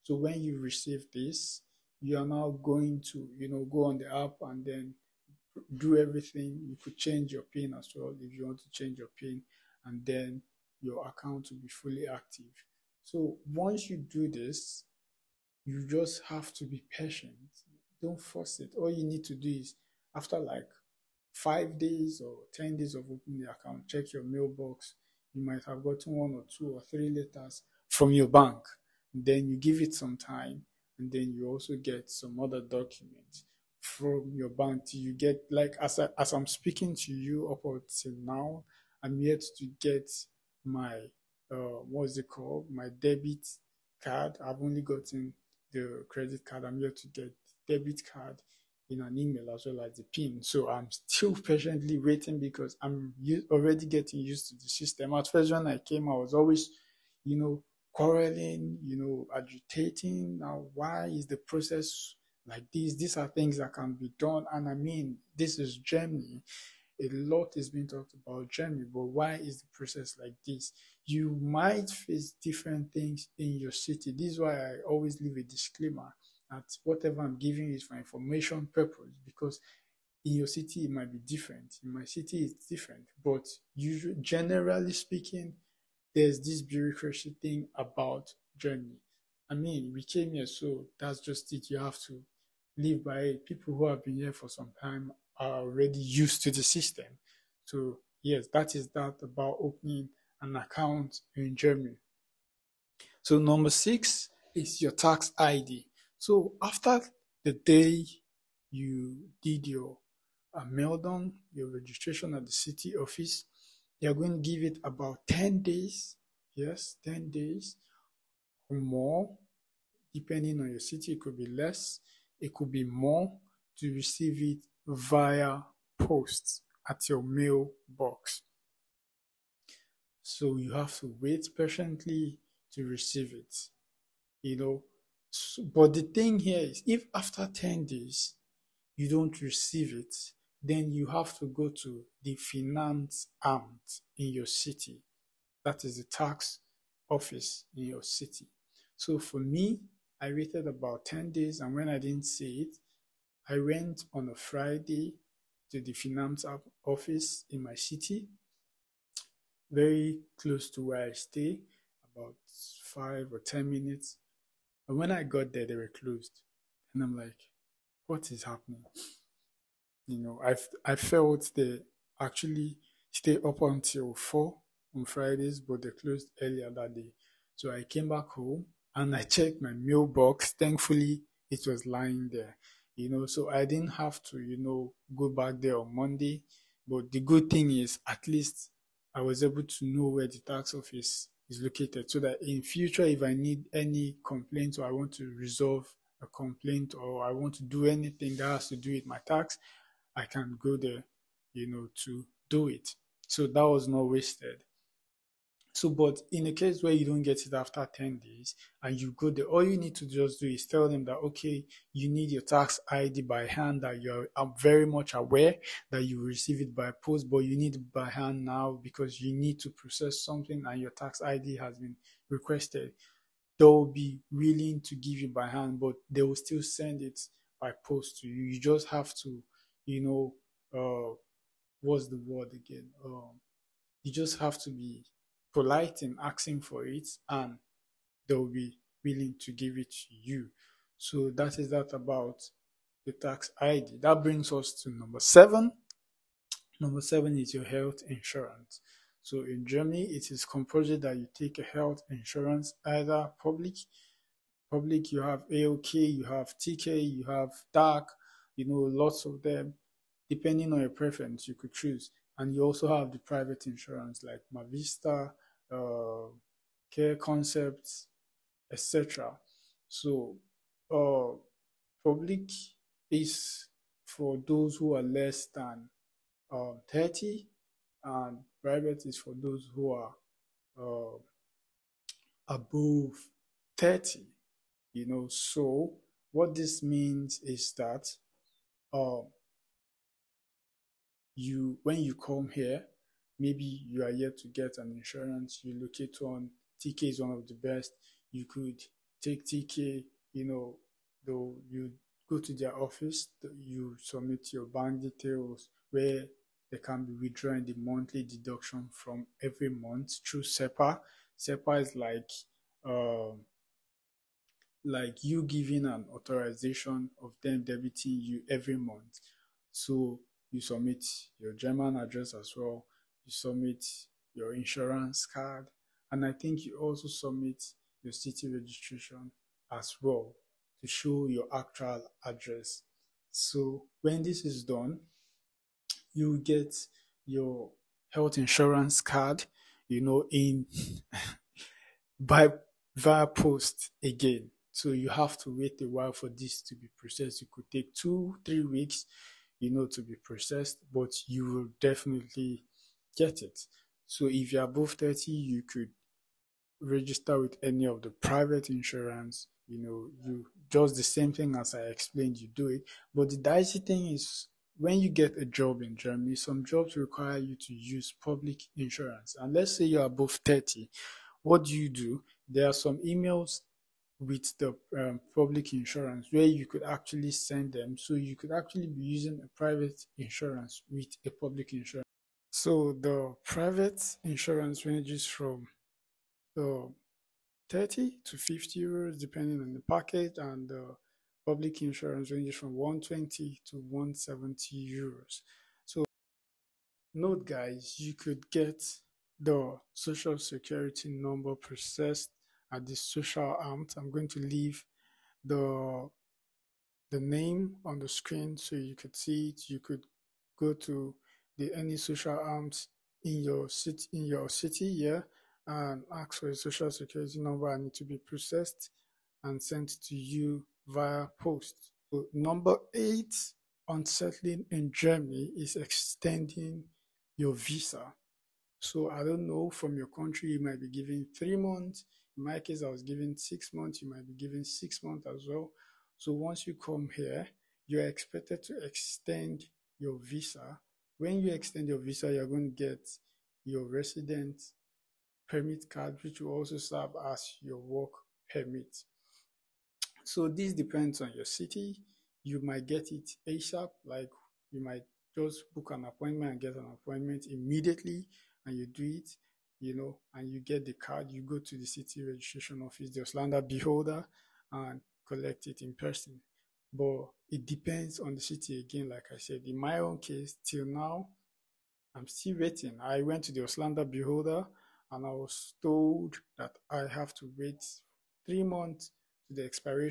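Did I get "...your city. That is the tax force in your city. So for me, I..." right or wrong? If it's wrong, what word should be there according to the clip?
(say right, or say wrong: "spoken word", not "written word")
wrong: "office", not "force".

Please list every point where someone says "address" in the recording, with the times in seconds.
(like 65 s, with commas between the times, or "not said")
321 s, 332 s.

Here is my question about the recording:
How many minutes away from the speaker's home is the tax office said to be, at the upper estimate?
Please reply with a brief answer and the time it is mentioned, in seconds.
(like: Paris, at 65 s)
10 minutes, at 163 s.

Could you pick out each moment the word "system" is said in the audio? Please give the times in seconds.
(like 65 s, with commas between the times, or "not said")
54 s, 96 s.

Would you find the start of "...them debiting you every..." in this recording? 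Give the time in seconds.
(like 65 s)
317 s.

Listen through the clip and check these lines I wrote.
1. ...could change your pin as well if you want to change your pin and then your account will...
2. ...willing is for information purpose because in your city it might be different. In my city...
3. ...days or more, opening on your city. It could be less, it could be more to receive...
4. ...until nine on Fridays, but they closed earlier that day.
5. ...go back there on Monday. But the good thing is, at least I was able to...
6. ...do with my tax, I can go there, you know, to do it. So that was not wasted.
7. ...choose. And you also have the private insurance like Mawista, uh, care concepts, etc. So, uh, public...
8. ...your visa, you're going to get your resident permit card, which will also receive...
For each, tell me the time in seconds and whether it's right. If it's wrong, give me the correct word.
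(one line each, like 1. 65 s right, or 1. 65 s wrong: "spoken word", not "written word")
1. 6 s right
2. 77 s wrong: "giving", not "willing"
3. 117 s wrong: "depending", not "opening"
4. 173 s wrong: "four", not "nine"
5. 185 s right
6. 198 s right
7. 261 s right
8. 441 s wrong: "serve", not "receive".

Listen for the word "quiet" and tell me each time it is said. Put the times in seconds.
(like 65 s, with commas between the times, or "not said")
not said.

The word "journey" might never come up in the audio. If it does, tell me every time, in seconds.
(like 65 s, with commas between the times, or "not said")
88 s.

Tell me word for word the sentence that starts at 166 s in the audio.
And I'm like, what is happening?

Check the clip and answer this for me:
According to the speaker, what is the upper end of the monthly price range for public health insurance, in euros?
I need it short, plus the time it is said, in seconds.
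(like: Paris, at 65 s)
170 euros, at 393 s.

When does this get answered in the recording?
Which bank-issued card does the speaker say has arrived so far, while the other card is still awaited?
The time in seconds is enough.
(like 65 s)
46 s.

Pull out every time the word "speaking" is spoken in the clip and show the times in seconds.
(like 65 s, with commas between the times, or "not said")
36 s, 84 s.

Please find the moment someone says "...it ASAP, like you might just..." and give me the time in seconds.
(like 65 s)
453 s.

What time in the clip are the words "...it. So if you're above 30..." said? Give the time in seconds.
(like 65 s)
353 s.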